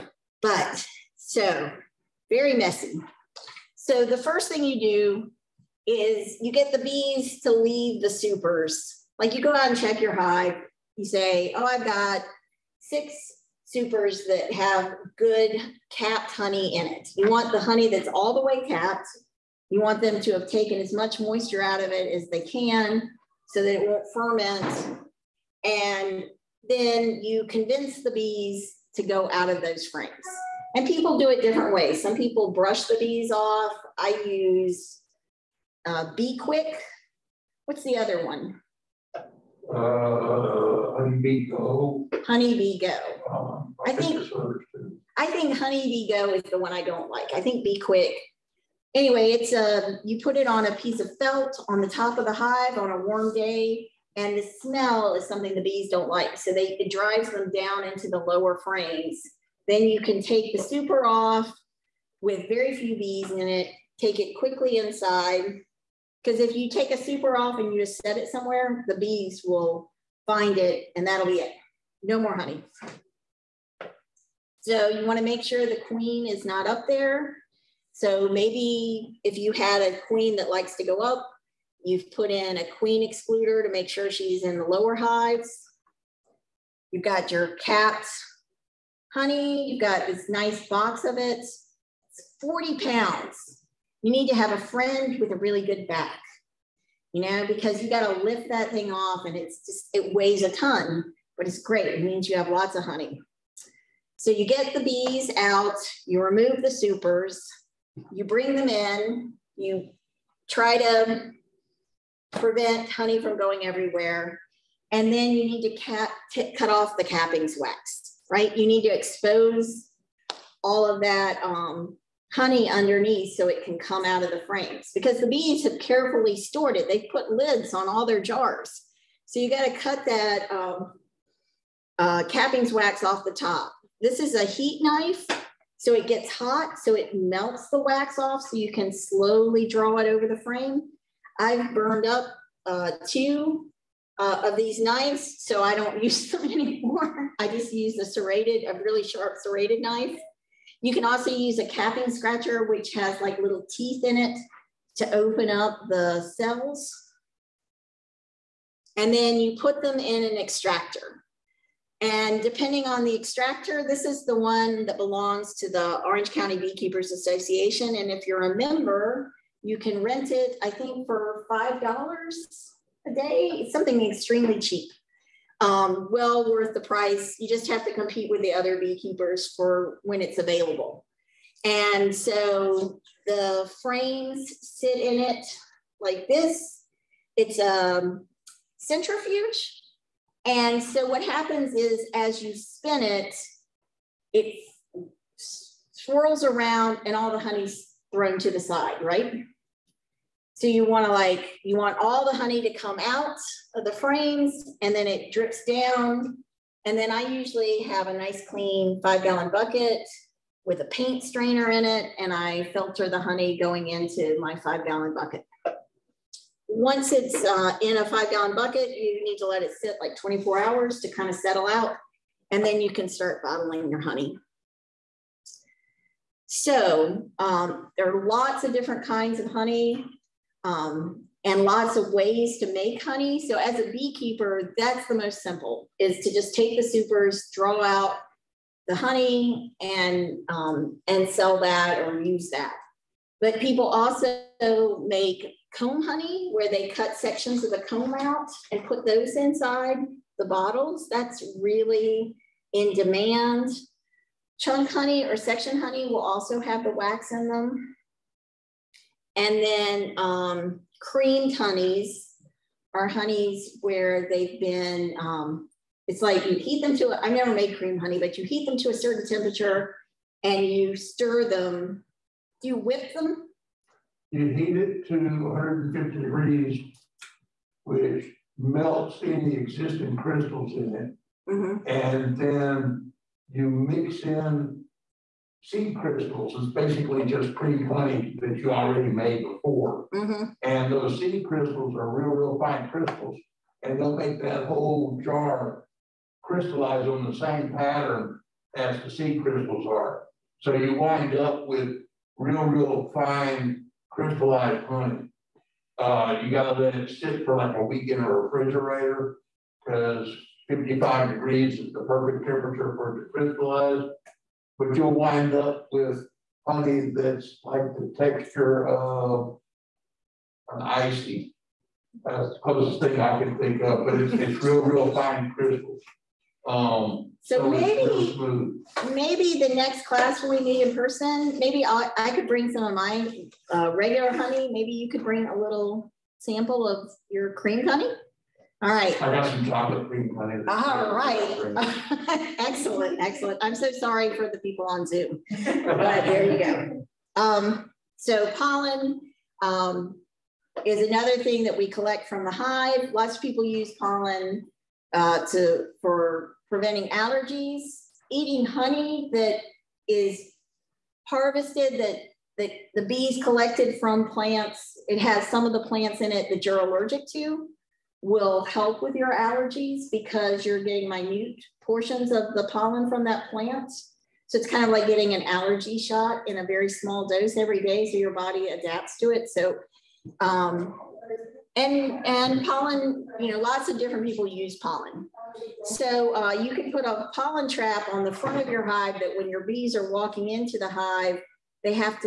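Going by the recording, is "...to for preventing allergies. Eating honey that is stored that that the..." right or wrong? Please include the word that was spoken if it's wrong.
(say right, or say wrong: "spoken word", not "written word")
wrong: "harvested", not "stored".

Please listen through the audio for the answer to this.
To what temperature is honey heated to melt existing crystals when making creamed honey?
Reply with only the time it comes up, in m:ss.
4:35.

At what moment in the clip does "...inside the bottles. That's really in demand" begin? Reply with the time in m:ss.
4:09.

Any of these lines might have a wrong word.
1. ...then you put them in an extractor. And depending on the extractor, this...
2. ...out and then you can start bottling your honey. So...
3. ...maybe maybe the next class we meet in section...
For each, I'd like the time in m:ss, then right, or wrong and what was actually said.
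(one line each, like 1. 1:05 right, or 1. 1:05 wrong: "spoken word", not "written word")
1. 2:39 right
2. 3:41 right
3. 5:27 wrong: "person", not "section".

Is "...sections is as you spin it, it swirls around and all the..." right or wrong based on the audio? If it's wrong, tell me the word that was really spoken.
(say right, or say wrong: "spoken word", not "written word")
wrong: "happens", not "sections".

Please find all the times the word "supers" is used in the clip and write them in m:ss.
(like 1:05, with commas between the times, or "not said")
0:08, 0:13, 1:00, 1:06, 1:46, 3:56.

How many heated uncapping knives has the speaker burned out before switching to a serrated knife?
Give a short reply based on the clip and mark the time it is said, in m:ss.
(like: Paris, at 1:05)
2, at 2:23.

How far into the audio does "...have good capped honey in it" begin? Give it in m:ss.
0:14.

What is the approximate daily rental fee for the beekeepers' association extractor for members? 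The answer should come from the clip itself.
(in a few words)
$5.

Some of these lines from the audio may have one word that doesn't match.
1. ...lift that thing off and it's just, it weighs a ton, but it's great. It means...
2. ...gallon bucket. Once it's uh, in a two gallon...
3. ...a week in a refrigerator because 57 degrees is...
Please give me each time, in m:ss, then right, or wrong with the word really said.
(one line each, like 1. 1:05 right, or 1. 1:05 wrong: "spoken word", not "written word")
1. 1:38 right
2. 3:34 wrong: "five", not "two"
3. 5:07 wrong: "55", not "57".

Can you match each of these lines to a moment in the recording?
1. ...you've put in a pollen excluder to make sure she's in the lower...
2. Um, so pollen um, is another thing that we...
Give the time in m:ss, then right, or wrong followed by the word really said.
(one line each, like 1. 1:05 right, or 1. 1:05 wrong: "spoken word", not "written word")
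1. 1:21 wrong: "queen", not "pollen"
2. 5:47 right.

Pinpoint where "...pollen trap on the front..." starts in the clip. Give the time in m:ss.
6:27.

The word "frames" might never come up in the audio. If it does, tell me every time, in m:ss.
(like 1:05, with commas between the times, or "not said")
0:29, 0:58, 2:04, 2:20, 3:03, 3:23.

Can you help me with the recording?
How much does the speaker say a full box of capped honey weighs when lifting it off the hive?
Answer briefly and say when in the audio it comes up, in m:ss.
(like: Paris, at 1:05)
40 pounds, at 1:32.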